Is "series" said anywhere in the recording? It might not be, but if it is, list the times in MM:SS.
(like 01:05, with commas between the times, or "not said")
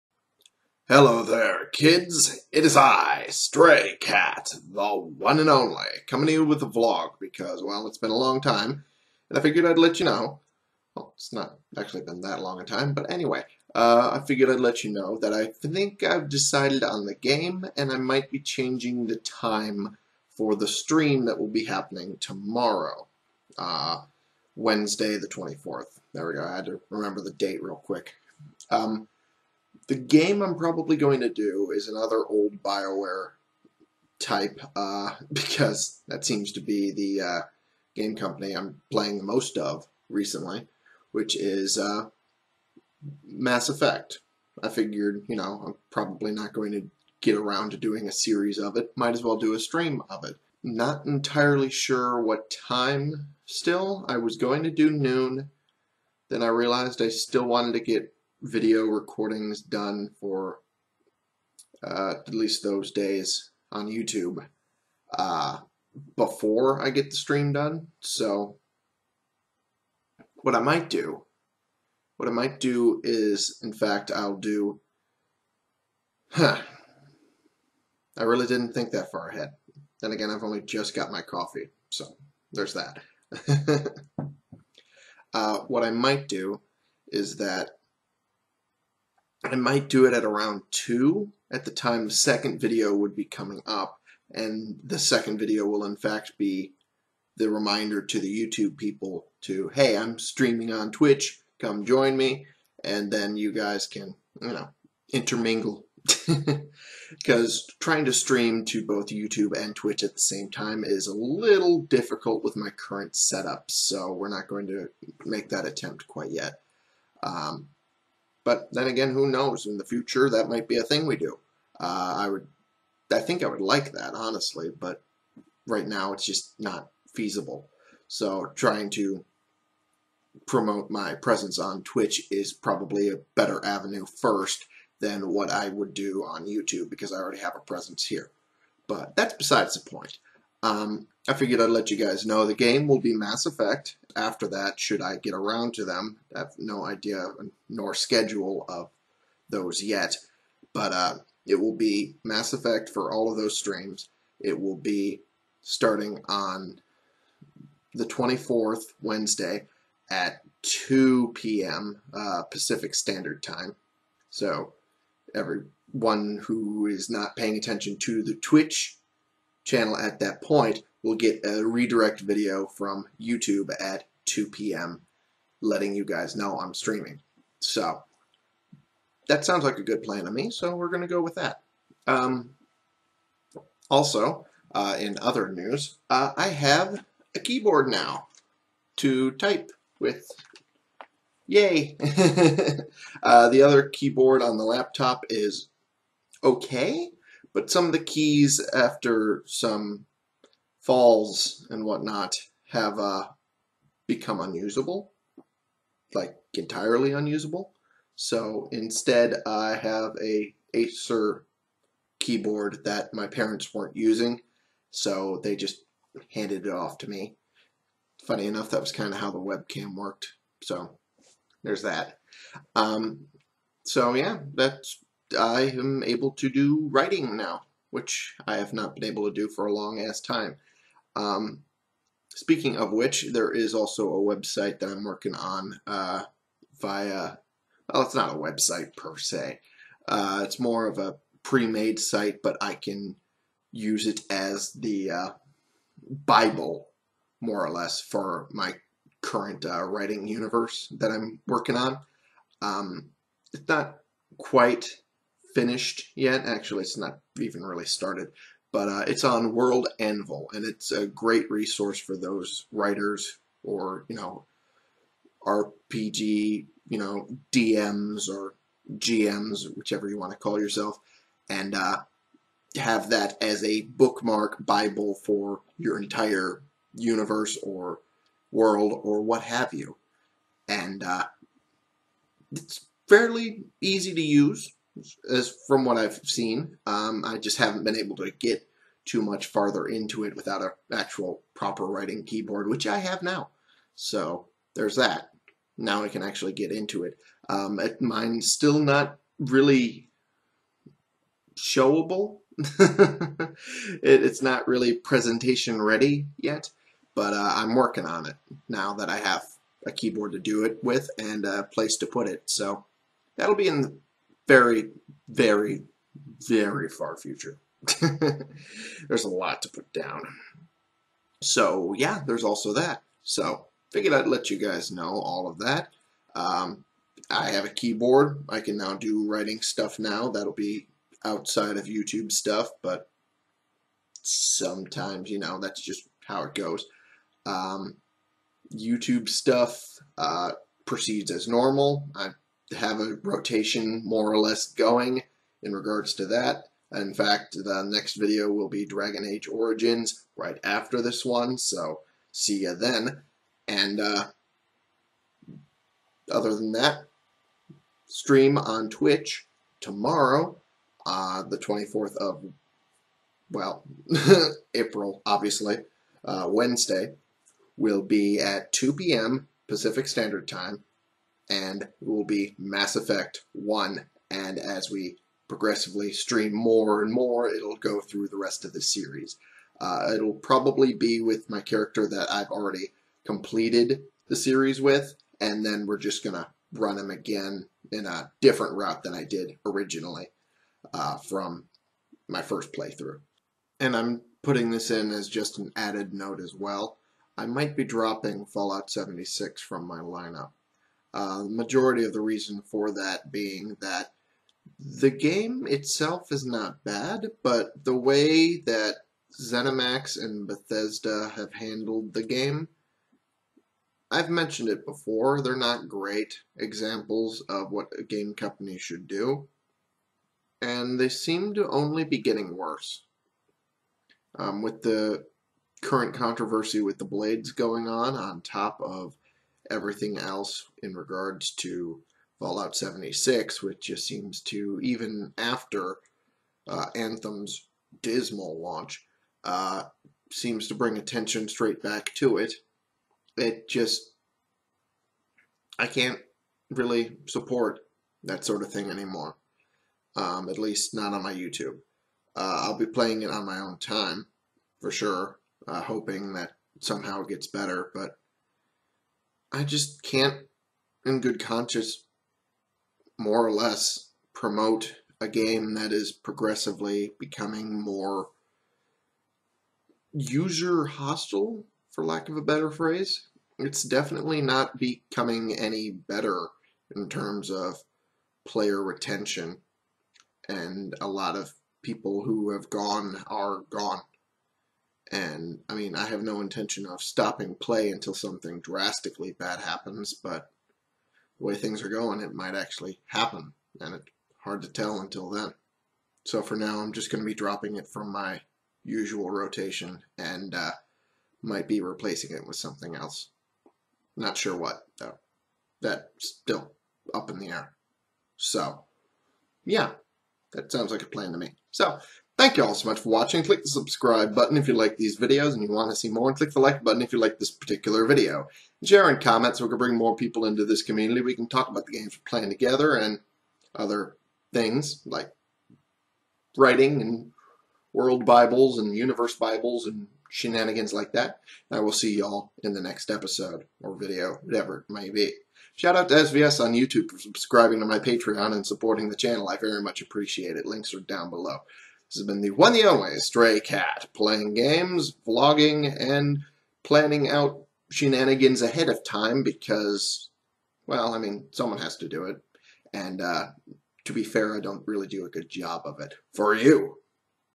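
00:48, 06:18, 06:24.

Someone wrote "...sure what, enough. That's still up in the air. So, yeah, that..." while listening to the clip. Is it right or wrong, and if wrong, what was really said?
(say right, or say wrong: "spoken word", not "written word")
wrong: "though", not "enough".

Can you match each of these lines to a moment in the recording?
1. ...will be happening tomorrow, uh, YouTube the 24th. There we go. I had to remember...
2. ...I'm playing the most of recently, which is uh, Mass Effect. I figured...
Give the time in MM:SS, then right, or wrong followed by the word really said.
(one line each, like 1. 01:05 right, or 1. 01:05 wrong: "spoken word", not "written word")
1. 00:21 wrong: "Wednesday", not "YouTube"
2. 00:38 right.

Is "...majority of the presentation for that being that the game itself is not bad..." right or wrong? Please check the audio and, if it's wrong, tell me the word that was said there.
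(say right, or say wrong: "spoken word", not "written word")
wrong: "reason", not "presentation".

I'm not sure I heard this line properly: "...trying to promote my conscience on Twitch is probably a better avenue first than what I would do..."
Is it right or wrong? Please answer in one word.
wrong.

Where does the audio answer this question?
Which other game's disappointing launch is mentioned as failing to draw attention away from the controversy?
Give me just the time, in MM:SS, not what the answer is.
07:16.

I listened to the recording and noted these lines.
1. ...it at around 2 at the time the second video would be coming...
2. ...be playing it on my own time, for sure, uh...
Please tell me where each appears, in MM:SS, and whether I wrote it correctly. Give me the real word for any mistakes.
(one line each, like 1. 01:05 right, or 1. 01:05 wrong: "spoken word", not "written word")
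1. 01:30 right
2. 07:32 right.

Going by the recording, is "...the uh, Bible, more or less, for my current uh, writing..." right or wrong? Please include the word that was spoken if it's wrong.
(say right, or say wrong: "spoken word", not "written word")
right.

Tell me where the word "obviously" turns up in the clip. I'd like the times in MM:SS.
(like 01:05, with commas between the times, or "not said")
06:05.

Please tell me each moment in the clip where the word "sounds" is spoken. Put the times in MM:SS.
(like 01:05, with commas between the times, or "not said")
02:59, 08:30.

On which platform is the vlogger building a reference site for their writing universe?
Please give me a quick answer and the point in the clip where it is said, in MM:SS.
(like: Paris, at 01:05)
World Anvil, at 04:19.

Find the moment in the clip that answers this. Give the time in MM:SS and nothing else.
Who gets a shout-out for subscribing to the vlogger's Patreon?
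08:56.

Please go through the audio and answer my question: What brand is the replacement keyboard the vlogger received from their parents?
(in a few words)
Acer.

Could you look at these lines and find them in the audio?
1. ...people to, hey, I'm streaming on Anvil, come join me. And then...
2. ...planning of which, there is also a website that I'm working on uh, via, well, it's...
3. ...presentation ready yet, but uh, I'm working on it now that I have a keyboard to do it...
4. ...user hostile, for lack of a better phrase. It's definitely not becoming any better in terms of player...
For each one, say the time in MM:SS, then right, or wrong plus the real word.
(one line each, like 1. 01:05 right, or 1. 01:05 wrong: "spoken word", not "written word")
1. 01:38 wrong: "Twitch", not "Anvil"
2. 03:52 wrong: "speaking", not "planning"
3. 05:04 right
4. 07:50 right.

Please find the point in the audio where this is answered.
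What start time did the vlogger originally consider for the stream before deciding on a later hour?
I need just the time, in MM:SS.
00:54.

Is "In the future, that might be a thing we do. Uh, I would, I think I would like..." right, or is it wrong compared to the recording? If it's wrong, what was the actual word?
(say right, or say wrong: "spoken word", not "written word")
right.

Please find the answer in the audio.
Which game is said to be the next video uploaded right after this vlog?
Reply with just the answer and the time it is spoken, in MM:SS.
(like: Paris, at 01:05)
Dragon Age Origins, at 05:48.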